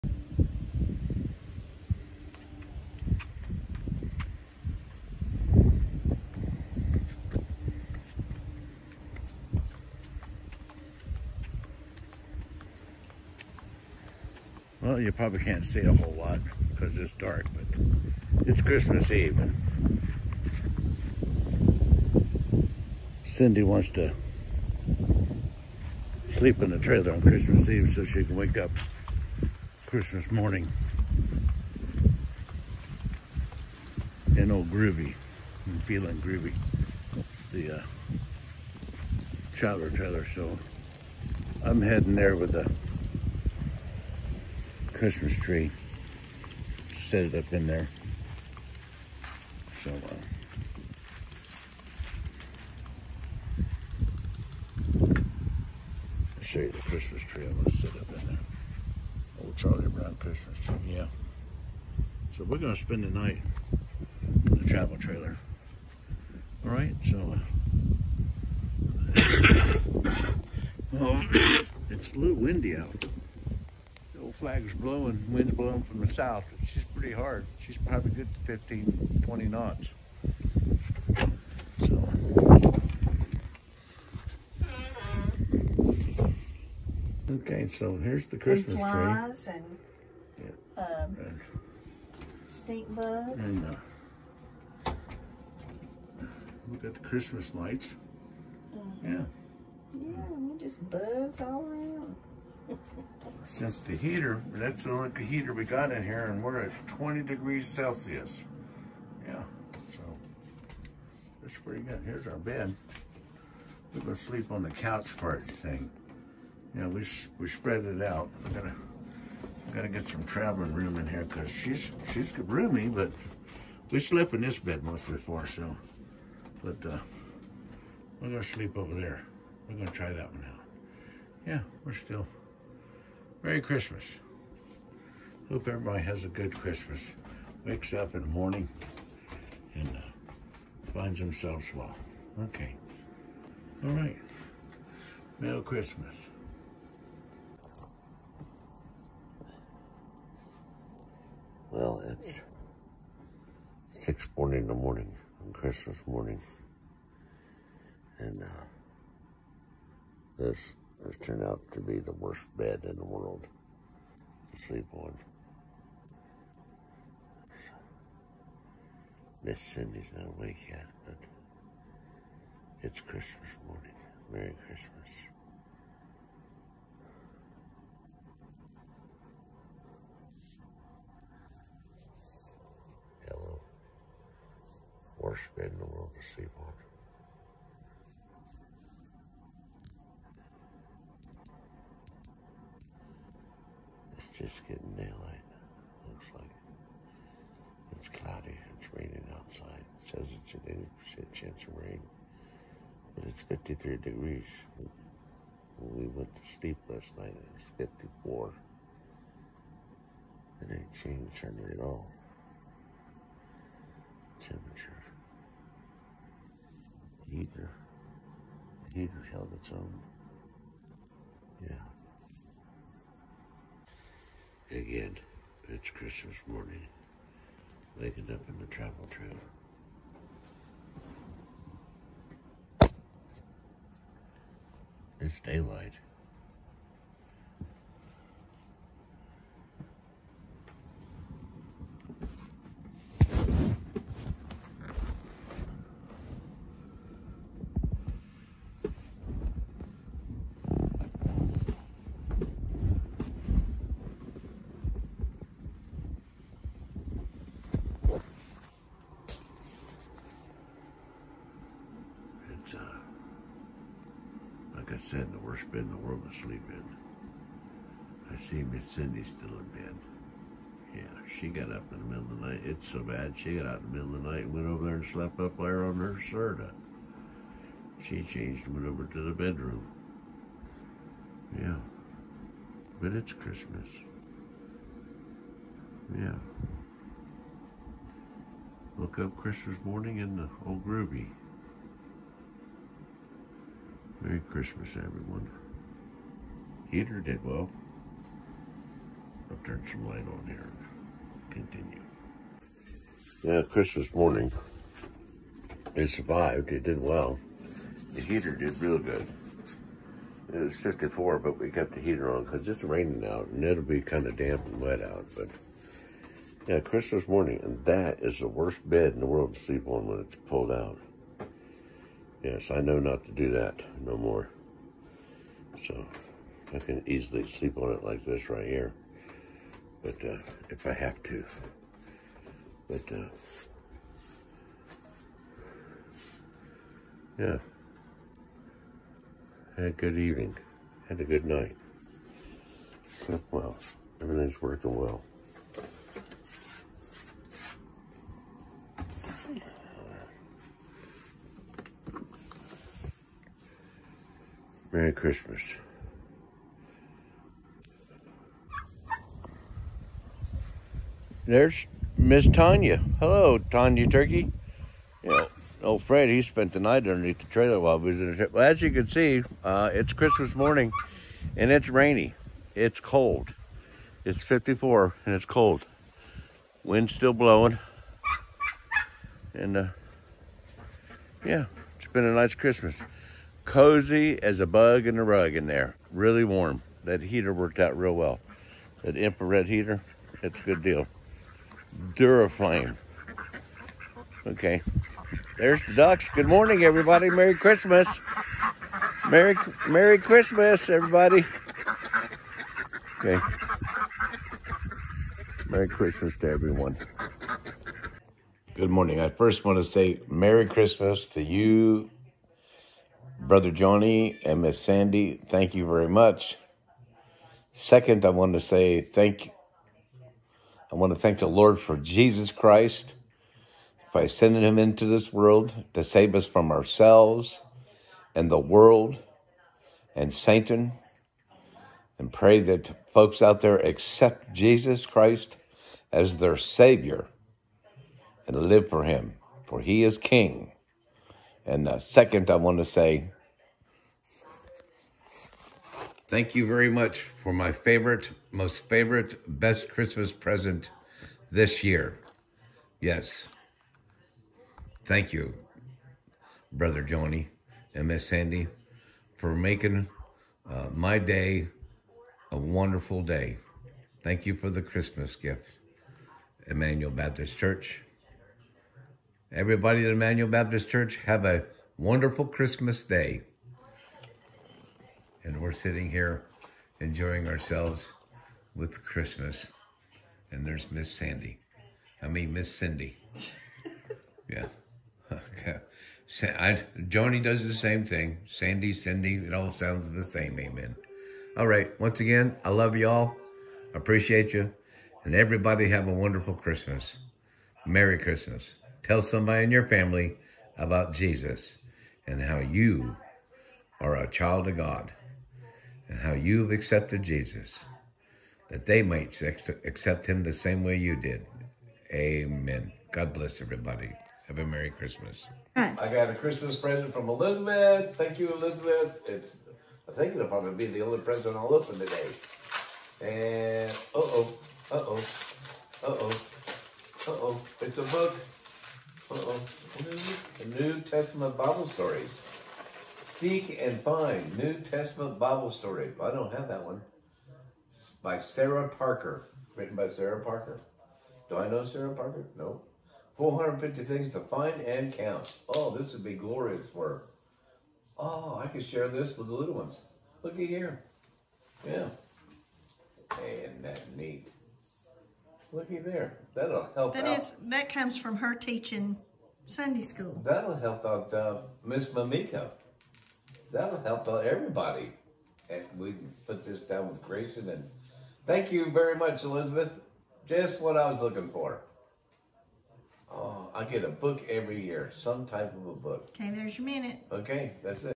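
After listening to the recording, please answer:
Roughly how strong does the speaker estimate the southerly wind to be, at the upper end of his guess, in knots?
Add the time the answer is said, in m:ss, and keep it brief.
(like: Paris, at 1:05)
20, at 1:19.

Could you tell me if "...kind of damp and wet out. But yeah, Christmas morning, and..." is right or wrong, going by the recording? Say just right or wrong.
right.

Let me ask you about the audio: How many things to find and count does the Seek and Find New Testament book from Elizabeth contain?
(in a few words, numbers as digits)
450.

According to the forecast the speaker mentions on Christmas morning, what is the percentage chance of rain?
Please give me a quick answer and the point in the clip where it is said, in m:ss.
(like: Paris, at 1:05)
80%, at 3:21.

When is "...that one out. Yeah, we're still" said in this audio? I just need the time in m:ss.
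2:10.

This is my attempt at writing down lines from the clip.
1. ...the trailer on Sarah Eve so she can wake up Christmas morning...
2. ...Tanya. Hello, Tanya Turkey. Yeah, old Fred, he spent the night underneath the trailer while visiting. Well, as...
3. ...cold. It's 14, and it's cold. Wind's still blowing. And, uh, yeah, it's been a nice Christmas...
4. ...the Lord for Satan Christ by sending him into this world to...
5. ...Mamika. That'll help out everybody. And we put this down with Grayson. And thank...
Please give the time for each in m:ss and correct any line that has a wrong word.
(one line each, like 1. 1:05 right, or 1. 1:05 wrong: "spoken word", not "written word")
1. 0:26 wrong: "Christmas", not "Sarah"
2. 6:02 right
3. 6:12 wrong: "54", not "14"
4. 7:01 wrong: "Jesus", not "Satan"
5. 9:22 right.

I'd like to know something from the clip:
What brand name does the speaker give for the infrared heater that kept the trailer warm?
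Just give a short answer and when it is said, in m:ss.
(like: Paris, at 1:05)
Duraflame, at 6:32.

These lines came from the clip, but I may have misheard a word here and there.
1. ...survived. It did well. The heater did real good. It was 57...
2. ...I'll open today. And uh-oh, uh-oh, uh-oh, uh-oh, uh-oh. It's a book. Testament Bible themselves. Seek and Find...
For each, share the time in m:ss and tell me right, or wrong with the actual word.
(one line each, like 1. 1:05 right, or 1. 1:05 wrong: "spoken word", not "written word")
1. 5:06 wrong: "54", not "57"
2. 8:41 wrong: "stories", not "themselves".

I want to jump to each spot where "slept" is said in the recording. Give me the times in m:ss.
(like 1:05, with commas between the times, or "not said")
2:03, 4:35, 5:43.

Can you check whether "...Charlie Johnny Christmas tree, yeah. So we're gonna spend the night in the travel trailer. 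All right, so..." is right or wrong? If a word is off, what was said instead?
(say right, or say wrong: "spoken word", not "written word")
wrong: "Brown", not "Johnny".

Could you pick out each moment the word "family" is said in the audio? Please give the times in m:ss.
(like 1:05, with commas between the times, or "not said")
8:19.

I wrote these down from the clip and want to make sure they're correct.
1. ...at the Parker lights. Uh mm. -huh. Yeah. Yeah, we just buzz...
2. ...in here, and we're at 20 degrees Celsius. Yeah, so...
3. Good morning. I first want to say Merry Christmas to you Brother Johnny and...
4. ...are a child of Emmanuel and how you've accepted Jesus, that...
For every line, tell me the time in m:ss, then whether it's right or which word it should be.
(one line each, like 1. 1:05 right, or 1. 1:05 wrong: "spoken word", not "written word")
1. 1:36 wrong: "Christmas", not "Parker"
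2. 1:45 right
3. 6:48 right
4. 8:23 wrong: "God", not "Emmanuel".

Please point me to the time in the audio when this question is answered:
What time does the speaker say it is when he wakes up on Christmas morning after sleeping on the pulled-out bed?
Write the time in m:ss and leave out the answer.
2:34.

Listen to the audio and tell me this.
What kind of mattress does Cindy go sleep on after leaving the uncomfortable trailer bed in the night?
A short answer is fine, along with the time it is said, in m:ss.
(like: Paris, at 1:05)
Serta, at 4:36.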